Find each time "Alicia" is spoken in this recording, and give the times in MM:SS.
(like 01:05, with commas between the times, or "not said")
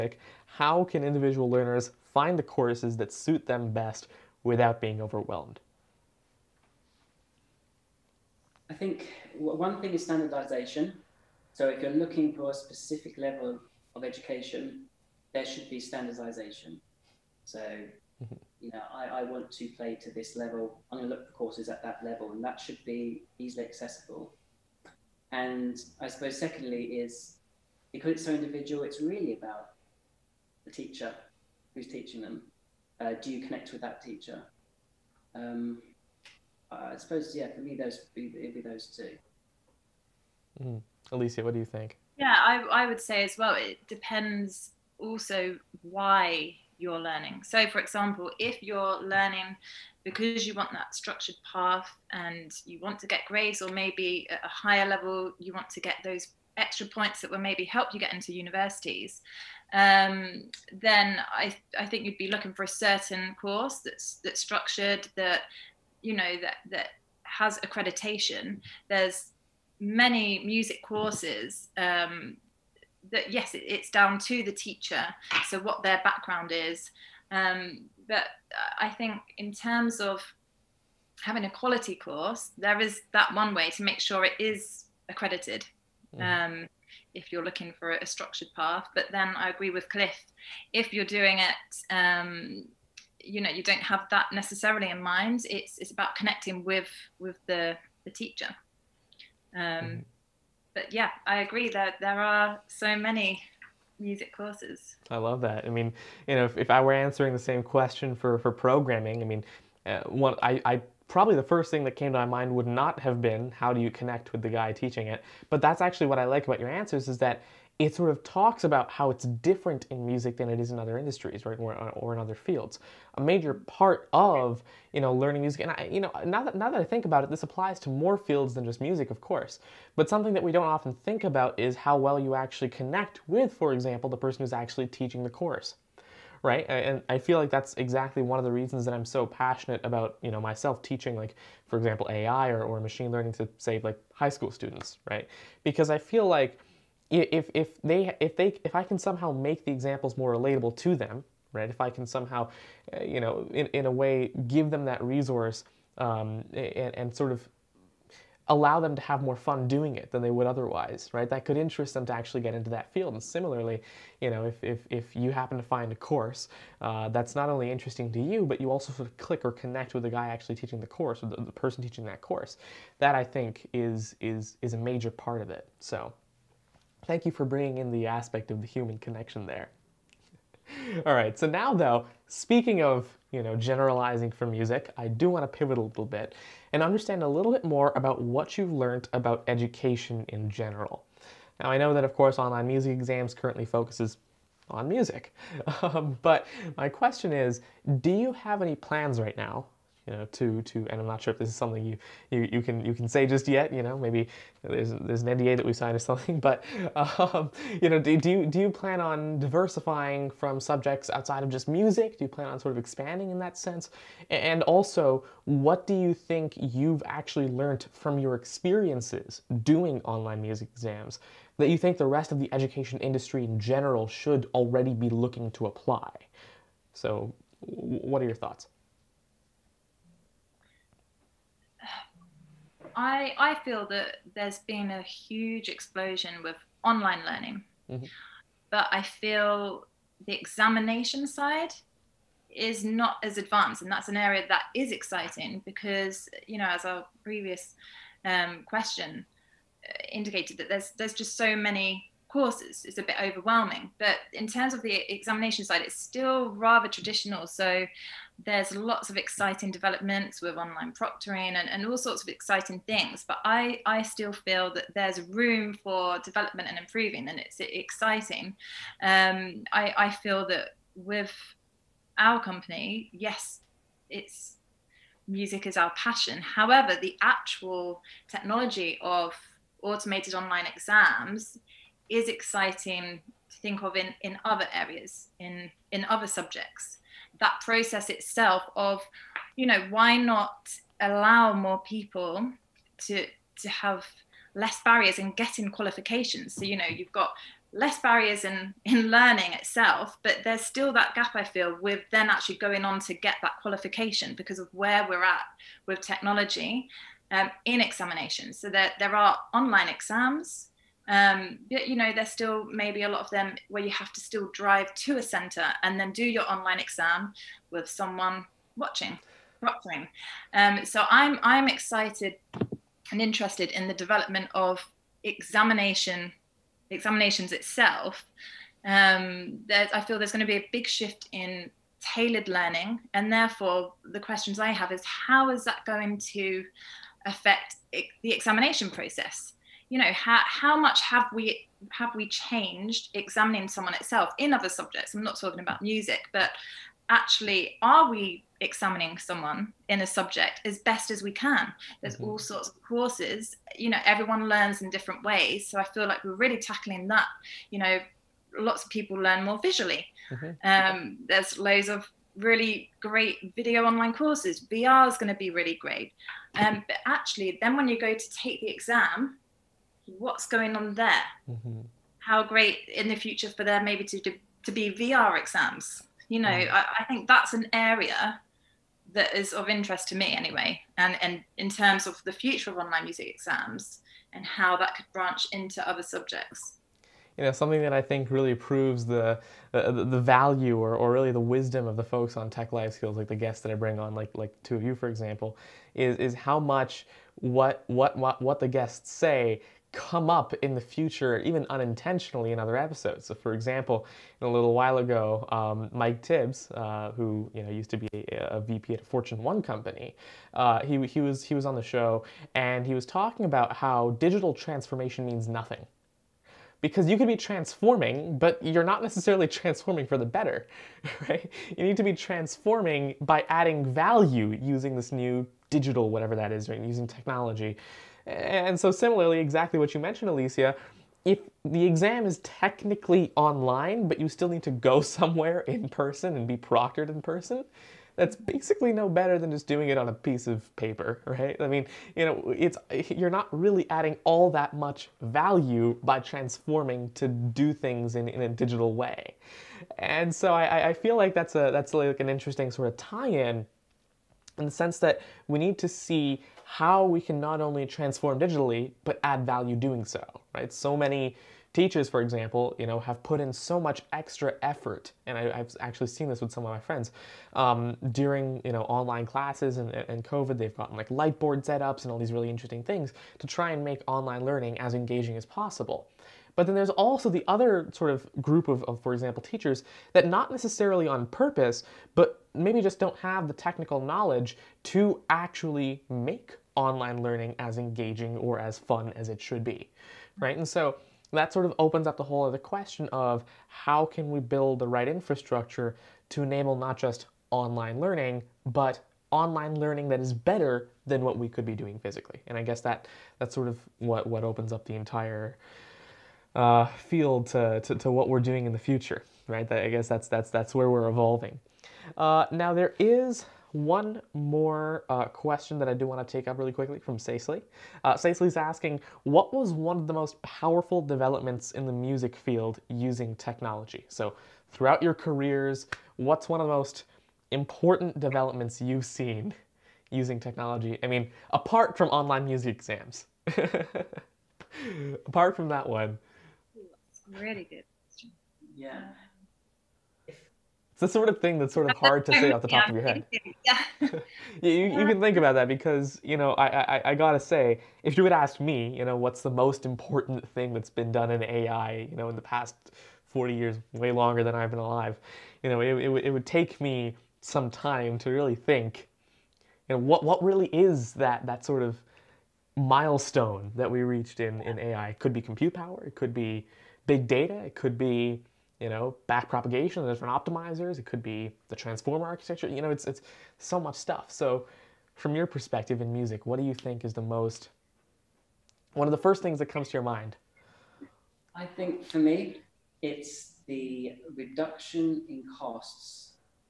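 00:41, 07:10.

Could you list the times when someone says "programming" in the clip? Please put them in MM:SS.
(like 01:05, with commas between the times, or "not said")
01:48.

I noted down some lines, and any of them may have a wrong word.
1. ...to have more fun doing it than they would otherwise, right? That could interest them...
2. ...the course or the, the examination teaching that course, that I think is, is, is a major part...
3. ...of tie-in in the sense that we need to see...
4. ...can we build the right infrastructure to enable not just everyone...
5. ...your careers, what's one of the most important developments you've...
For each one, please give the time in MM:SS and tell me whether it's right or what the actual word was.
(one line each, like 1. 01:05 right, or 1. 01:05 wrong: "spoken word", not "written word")
1. 02:38 right
2. 02:50 wrong: "person", not "examination"
3. 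07:32 right
4. 08:14 wrong: "online", not "everyone"
5. 08:45 right.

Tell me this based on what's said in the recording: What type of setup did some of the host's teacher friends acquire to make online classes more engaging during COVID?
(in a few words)
light board.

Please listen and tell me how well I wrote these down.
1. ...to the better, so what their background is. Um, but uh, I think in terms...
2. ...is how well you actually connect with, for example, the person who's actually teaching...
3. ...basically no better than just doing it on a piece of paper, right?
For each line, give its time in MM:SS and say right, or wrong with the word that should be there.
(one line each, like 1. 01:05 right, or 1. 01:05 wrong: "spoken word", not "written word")
1. 01:14 wrong: "teacher", not "better"
2. 02:11 right
3. 07:18 right.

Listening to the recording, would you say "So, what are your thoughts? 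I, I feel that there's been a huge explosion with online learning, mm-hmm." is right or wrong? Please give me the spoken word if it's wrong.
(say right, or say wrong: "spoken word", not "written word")
right.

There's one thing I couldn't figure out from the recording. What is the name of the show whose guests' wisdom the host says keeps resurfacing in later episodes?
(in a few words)
Tech Life Skills.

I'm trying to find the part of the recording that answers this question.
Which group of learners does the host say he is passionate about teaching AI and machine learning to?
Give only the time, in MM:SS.
02:24.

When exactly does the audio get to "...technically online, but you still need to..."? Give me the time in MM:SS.
07:12.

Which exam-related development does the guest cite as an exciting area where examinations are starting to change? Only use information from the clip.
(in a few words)
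online proctoring.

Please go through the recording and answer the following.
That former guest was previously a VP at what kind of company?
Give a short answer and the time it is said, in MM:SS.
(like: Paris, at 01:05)
Fortune One company, at 06:49.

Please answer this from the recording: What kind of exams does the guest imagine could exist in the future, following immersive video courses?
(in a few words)
VR exams.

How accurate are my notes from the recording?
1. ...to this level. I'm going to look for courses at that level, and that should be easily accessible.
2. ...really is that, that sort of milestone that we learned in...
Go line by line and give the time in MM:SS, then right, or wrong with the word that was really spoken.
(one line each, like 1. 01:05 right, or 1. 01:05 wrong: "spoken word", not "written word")
1. 00:20 right
2. 09:20 wrong: "reached", not "learned".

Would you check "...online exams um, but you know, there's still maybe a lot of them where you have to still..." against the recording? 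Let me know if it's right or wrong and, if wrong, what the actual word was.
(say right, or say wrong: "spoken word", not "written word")
right.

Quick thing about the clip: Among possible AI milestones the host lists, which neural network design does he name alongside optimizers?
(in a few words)
transformer architecture.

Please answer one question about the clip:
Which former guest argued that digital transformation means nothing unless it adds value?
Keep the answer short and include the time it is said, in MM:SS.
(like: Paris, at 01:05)
Mike Tibbs, at 06:45.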